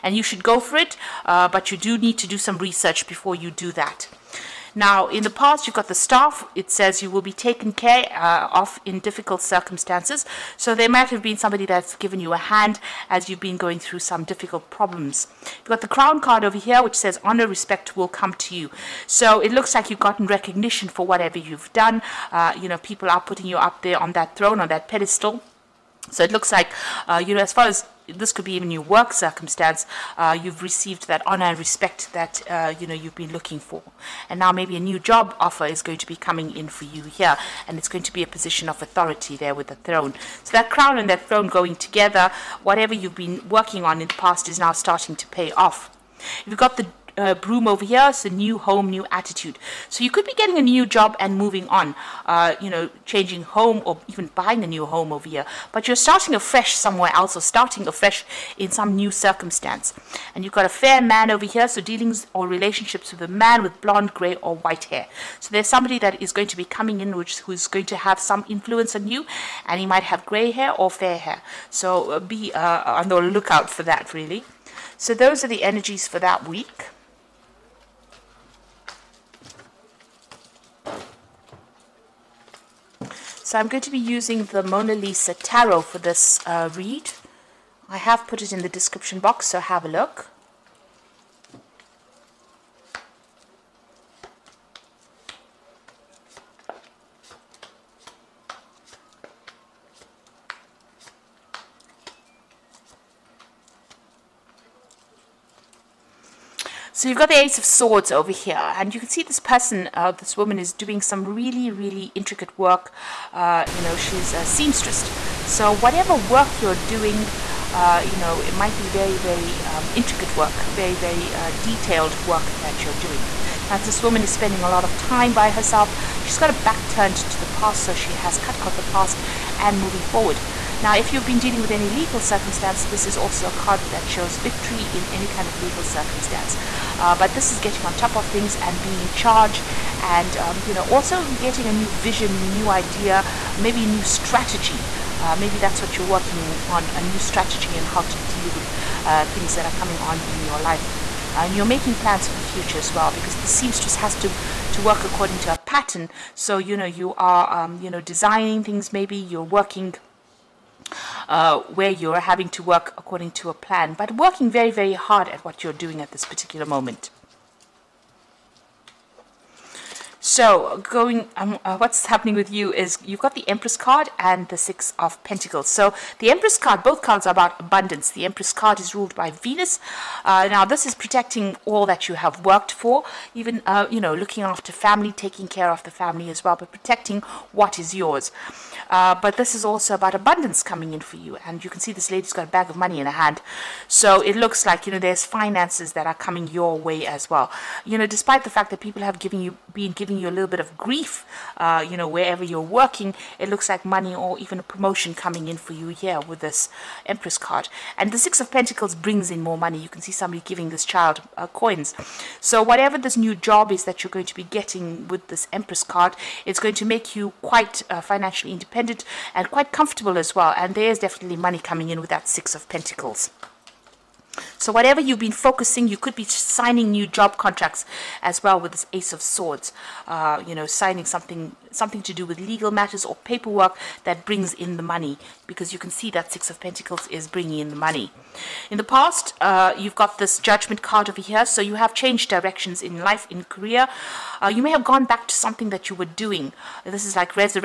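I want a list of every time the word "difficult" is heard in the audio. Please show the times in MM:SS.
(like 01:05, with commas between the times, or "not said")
00:08, 00:14.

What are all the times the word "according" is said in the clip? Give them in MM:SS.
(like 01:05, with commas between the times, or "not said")
02:35, 02:42.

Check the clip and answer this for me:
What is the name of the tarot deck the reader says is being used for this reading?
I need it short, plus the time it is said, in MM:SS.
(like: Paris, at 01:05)
Mona Lisa Tarot, at 01:24.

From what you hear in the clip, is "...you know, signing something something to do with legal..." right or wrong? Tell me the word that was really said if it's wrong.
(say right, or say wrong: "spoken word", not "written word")
right.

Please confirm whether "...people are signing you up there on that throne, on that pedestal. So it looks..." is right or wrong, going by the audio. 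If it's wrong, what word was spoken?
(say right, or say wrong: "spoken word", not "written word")
wrong: "putting", not "signing".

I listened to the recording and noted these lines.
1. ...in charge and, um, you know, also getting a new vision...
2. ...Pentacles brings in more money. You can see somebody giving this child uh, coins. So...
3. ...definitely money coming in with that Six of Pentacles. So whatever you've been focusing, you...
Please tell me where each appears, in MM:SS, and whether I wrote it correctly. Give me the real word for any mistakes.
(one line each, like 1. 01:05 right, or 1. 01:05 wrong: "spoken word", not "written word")
1. 02:19 right
2. 03:28 right
3. 03:40 right.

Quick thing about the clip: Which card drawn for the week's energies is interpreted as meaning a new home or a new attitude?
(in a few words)
Broom.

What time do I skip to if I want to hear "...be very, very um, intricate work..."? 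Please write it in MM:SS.
01:58.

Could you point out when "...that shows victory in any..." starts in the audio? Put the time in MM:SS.
02:13.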